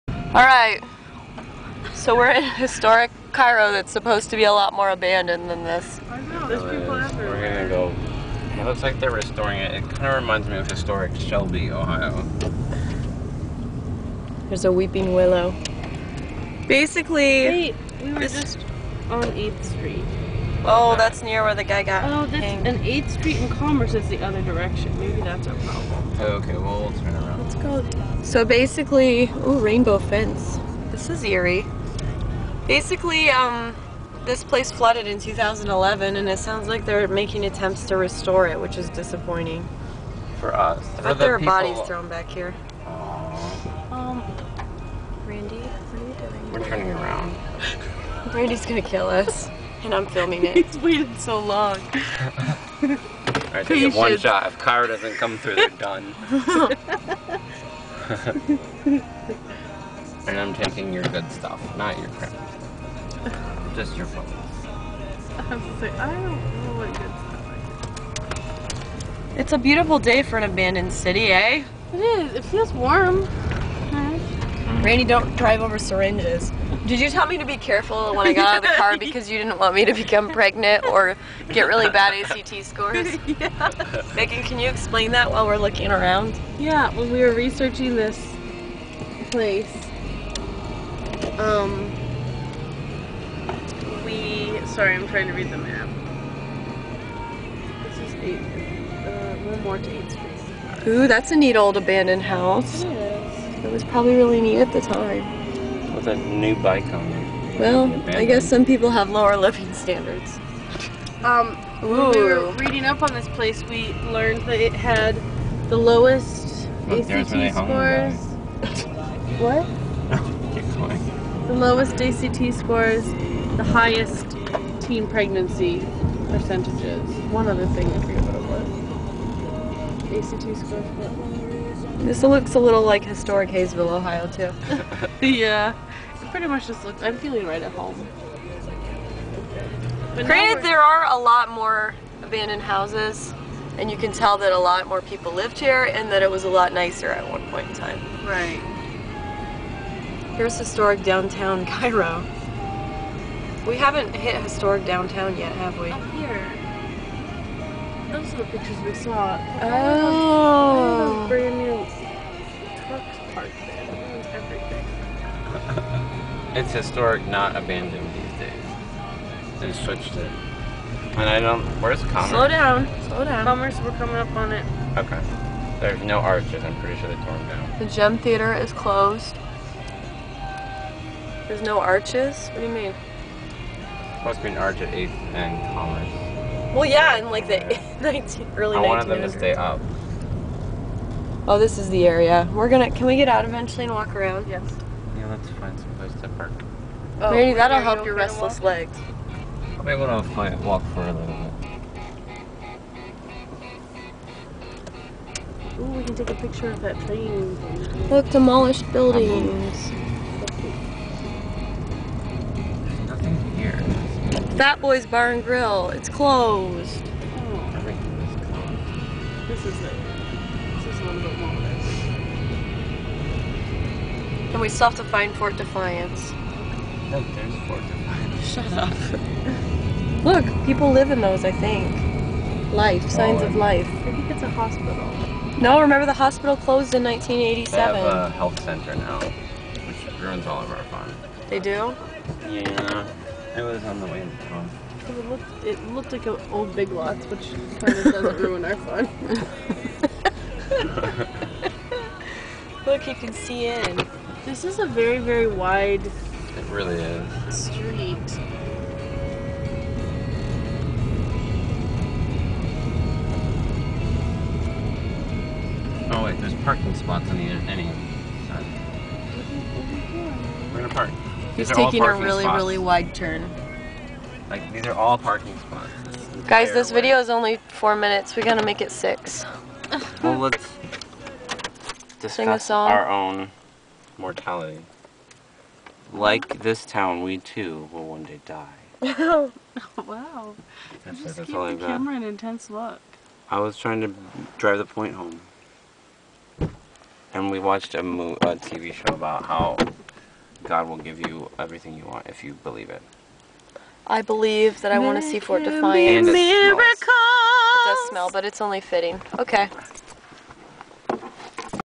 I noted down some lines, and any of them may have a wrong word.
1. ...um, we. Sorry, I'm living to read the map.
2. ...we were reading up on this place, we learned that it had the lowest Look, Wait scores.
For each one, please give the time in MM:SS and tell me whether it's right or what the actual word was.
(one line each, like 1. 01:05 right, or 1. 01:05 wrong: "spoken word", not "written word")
1. 01:31 wrong: "trying", not "living"
2. 01:52 wrong: "ACT", not "Wait".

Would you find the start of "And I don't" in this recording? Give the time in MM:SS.
02:51.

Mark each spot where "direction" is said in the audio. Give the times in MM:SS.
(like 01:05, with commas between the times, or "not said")
00:24.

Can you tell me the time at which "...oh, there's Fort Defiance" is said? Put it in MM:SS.
03:47.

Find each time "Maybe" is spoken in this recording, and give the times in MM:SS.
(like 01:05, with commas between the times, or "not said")
00:24, 03:17.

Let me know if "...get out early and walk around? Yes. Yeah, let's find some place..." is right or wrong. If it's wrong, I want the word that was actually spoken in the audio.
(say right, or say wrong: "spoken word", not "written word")
wrong: "eventually", not "early".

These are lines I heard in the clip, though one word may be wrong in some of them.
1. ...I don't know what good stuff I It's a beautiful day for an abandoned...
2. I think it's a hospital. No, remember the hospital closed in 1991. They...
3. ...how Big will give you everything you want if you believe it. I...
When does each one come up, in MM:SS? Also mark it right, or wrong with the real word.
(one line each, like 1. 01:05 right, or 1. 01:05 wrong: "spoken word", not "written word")
1. 01:05 right
2. 03:53 wrong: "1987", not "1991"
3. 04:59 wrong: "God", not "Big".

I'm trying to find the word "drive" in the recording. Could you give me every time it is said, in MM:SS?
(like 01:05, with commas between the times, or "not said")
01:15, 04:54.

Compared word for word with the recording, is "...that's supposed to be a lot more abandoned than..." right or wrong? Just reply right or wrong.
right.